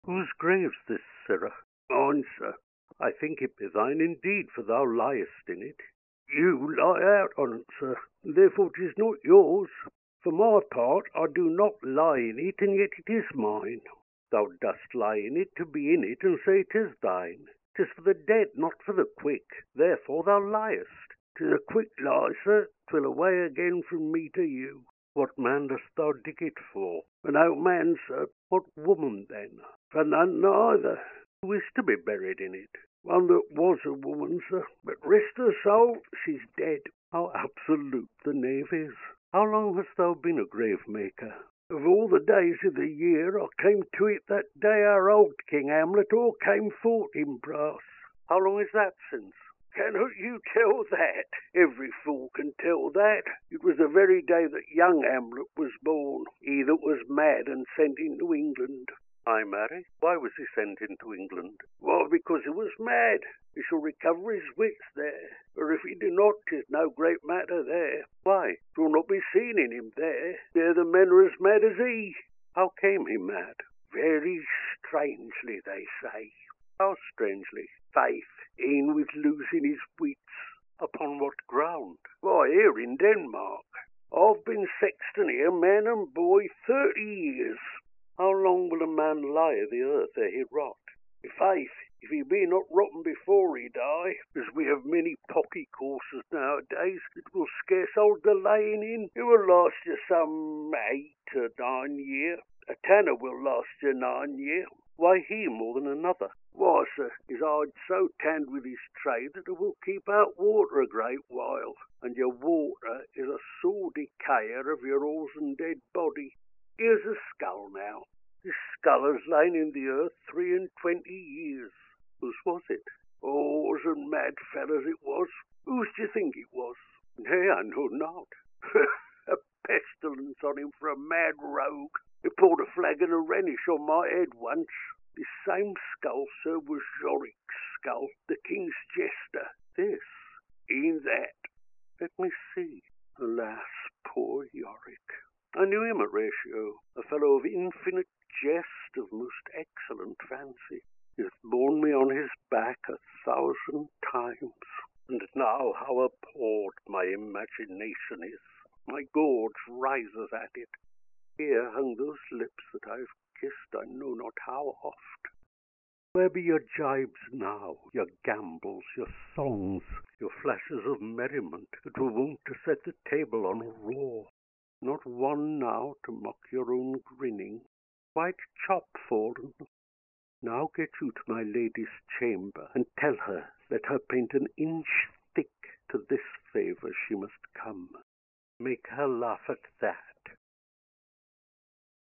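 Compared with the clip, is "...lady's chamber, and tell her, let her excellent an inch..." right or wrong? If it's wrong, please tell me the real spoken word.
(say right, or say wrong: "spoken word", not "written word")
wrong: "paint", not "excellent".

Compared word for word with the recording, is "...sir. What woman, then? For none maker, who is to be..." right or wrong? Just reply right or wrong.
wrong.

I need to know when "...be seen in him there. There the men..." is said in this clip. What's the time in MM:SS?
01:09.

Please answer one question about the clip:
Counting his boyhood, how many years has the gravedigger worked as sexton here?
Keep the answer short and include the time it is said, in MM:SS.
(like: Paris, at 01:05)
30, at 01:26.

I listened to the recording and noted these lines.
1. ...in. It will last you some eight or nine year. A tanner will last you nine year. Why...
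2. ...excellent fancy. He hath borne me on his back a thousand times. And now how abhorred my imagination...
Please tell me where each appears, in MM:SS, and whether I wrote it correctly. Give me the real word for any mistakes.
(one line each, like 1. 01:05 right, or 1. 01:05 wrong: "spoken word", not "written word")
1. 01:38 right
2. 02:29 right.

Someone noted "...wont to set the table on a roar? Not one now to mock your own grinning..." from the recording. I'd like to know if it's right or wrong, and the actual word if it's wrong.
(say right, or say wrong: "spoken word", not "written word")
right.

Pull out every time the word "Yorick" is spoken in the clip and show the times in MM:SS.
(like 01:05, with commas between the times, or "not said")
02:17, 02:24.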